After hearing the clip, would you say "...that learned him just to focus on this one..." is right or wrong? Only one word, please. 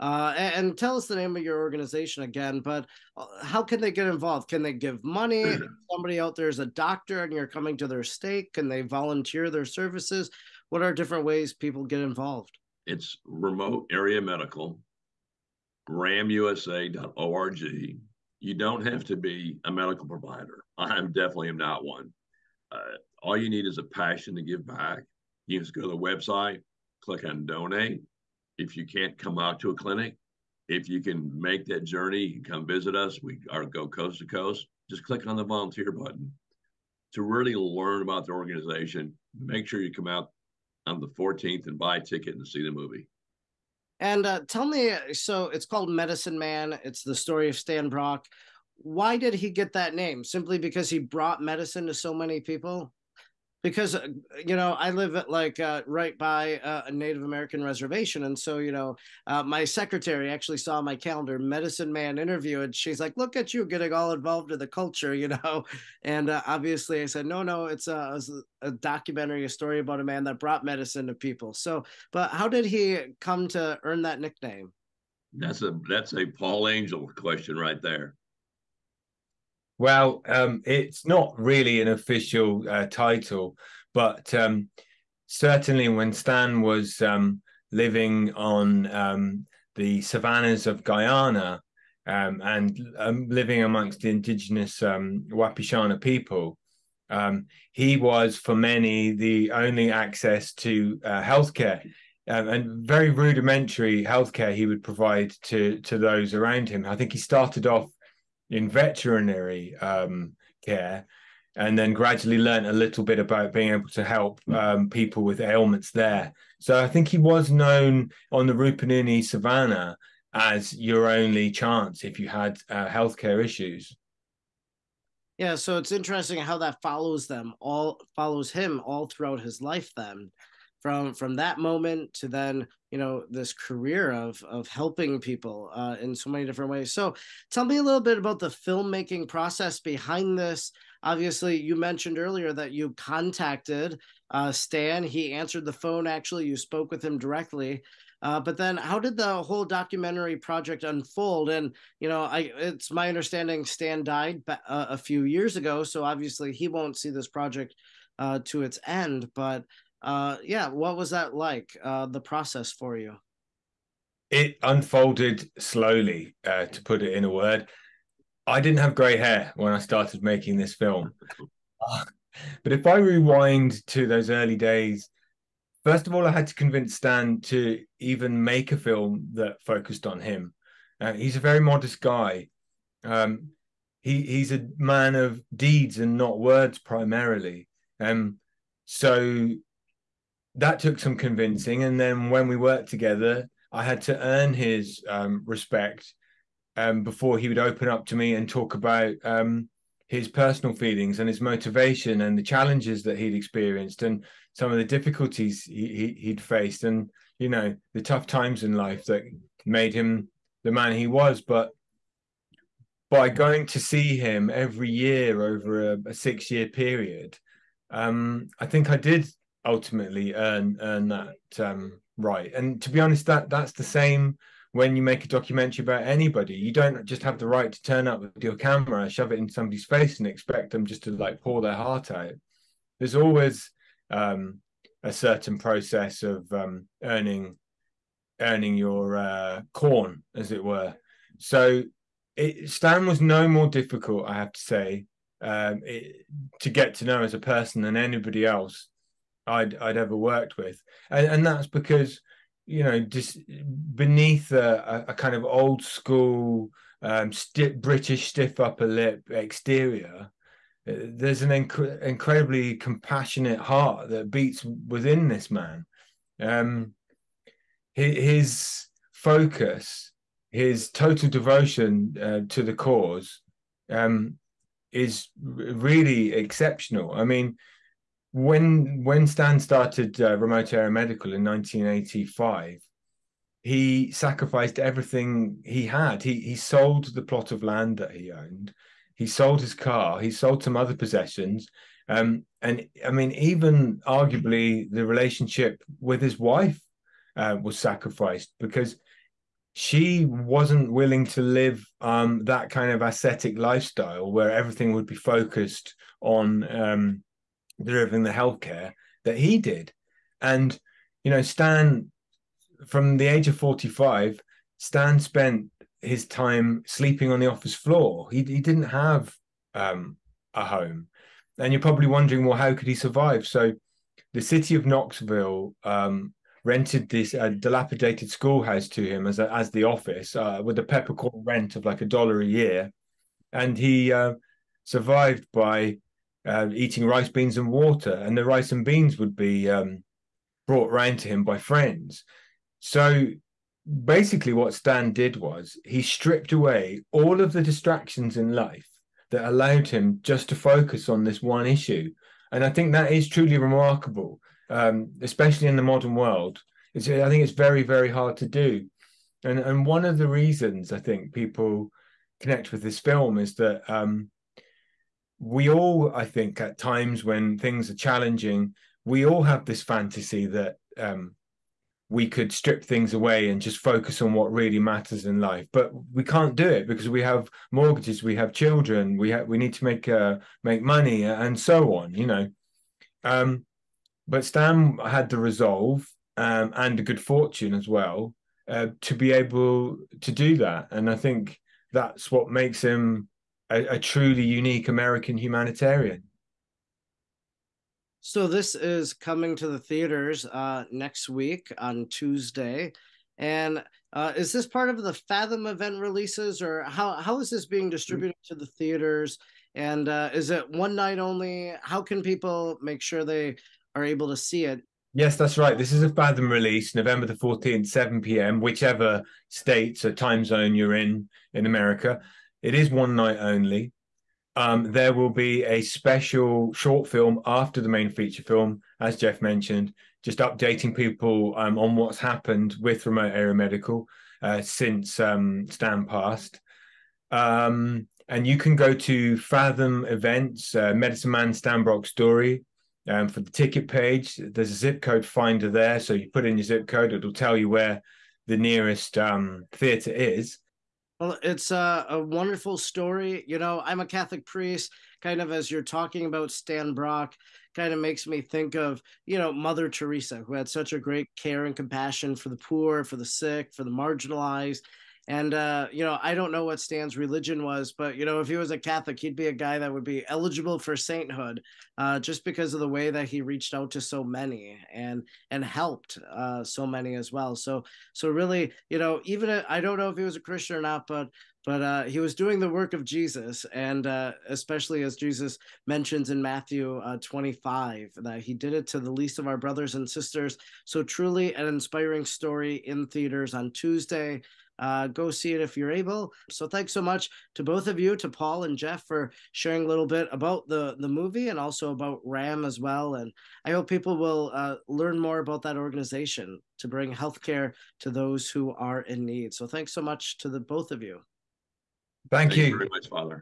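wrong.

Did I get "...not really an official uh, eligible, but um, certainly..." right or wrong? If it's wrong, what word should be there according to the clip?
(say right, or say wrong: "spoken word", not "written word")
wrong: "title", not "eligible".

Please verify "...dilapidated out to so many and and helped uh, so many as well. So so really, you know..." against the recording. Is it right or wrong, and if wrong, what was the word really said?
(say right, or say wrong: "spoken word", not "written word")
wrong: "reached", not "dilapidated".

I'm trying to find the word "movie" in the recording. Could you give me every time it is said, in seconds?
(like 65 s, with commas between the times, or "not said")
42 s, 501 s.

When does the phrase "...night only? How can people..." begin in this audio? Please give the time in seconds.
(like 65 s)
410 s.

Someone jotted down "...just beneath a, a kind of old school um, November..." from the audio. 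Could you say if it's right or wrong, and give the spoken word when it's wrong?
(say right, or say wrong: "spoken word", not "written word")
wrong: "British", not "November".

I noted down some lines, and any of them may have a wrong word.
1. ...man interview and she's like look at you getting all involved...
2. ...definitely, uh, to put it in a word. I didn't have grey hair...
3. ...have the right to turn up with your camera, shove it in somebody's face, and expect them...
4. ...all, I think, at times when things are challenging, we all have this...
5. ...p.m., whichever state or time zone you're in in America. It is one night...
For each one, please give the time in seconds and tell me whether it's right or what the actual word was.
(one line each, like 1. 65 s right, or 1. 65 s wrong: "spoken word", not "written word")
1. 61 s right
2. 165 s wrong: "slowly", not "definitely"
3. 227 s right
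4. 365 s right
5. 418 s right.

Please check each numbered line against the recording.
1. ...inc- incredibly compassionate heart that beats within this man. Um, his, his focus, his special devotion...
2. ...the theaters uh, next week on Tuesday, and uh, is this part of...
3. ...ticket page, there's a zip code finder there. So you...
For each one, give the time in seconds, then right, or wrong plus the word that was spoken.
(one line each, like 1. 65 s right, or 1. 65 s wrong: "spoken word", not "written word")
1. 261 s wrong: "total", not "special"
2. 399 s right
3. 443 s right.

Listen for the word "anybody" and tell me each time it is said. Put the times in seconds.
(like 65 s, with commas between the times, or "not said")
226 s, 247 s.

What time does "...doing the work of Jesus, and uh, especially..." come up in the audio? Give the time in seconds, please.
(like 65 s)
482 s.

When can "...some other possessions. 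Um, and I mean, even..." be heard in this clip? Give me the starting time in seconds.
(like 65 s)
290 s.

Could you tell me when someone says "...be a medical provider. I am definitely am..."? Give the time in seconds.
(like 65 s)
19 s.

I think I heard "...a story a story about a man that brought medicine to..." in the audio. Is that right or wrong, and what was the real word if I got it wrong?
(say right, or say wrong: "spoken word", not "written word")
wrong: "documentary", not "story".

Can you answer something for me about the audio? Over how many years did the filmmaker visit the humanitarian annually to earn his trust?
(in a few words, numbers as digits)
6.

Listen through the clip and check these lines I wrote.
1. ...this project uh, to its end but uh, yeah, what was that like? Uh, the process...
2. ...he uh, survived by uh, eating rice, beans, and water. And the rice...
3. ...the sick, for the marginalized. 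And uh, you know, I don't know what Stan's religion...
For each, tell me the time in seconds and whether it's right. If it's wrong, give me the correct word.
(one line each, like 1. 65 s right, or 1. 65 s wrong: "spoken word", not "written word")
1. 157 s right
2. 333 s right
3. 463 s right.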